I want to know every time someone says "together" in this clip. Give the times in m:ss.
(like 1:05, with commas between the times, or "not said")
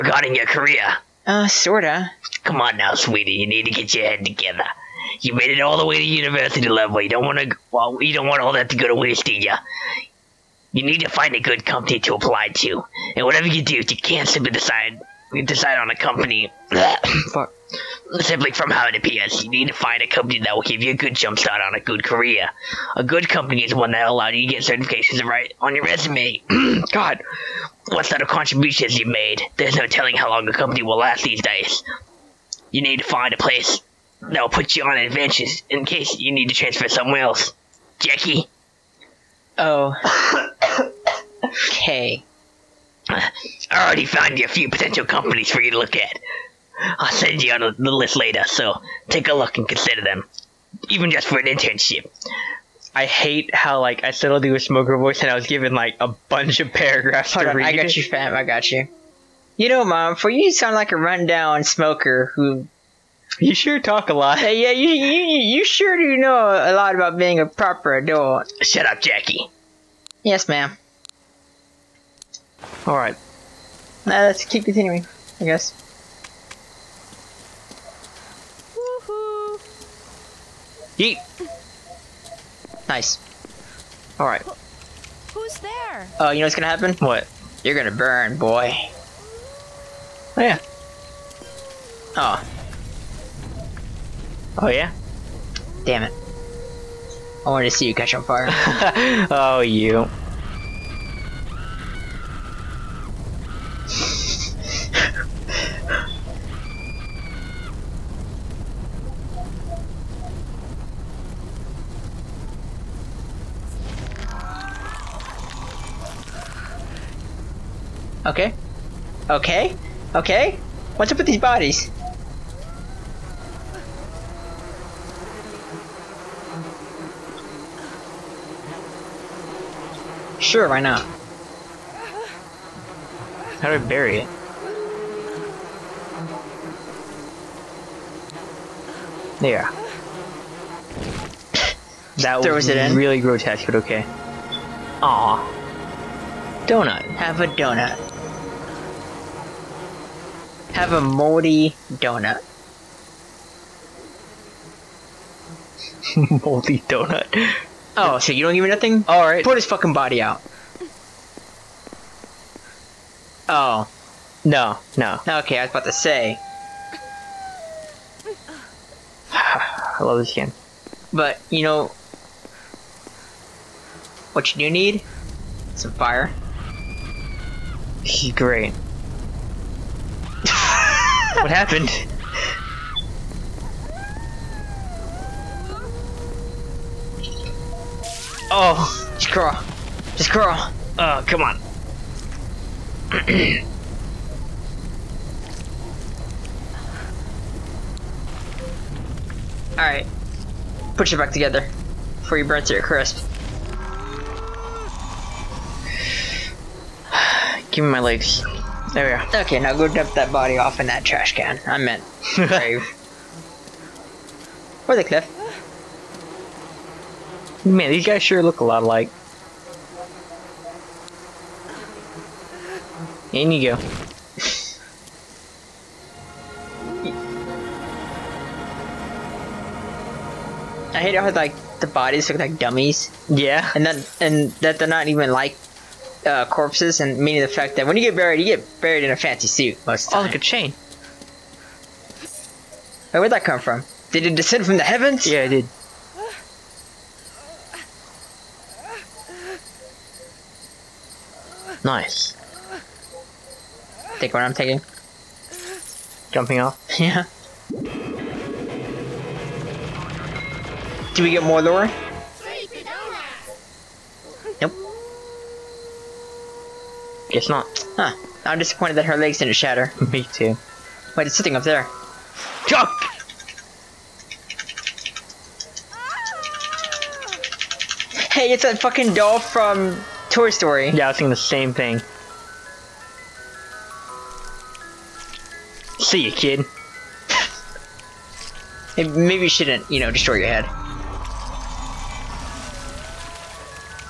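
0:04, 3:21.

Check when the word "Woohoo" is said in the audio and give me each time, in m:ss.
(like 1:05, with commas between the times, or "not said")
1:18.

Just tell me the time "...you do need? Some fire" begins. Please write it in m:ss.
2:54.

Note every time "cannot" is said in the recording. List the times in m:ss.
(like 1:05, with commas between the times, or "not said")
not said.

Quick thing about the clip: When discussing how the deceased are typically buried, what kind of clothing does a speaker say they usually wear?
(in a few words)
fancy suit.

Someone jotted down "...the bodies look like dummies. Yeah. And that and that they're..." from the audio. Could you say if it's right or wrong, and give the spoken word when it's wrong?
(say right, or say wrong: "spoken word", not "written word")
right.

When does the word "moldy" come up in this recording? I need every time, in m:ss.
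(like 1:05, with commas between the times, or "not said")
2:31, 2:36.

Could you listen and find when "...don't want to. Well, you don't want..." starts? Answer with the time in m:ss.
0:07.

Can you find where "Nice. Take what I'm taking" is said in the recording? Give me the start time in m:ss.
4:11.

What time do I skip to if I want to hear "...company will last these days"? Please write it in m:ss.
0:30.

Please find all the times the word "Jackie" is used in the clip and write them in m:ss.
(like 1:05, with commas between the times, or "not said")
0:37, 1:09.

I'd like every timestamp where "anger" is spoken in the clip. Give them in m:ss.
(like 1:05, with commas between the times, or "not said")
not said.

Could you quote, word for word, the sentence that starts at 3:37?
Man, these guys sure look a lot alike.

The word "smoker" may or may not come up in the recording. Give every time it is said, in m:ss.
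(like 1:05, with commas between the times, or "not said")
0:54, 1:01.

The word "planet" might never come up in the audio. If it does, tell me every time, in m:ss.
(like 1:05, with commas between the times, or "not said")
not said.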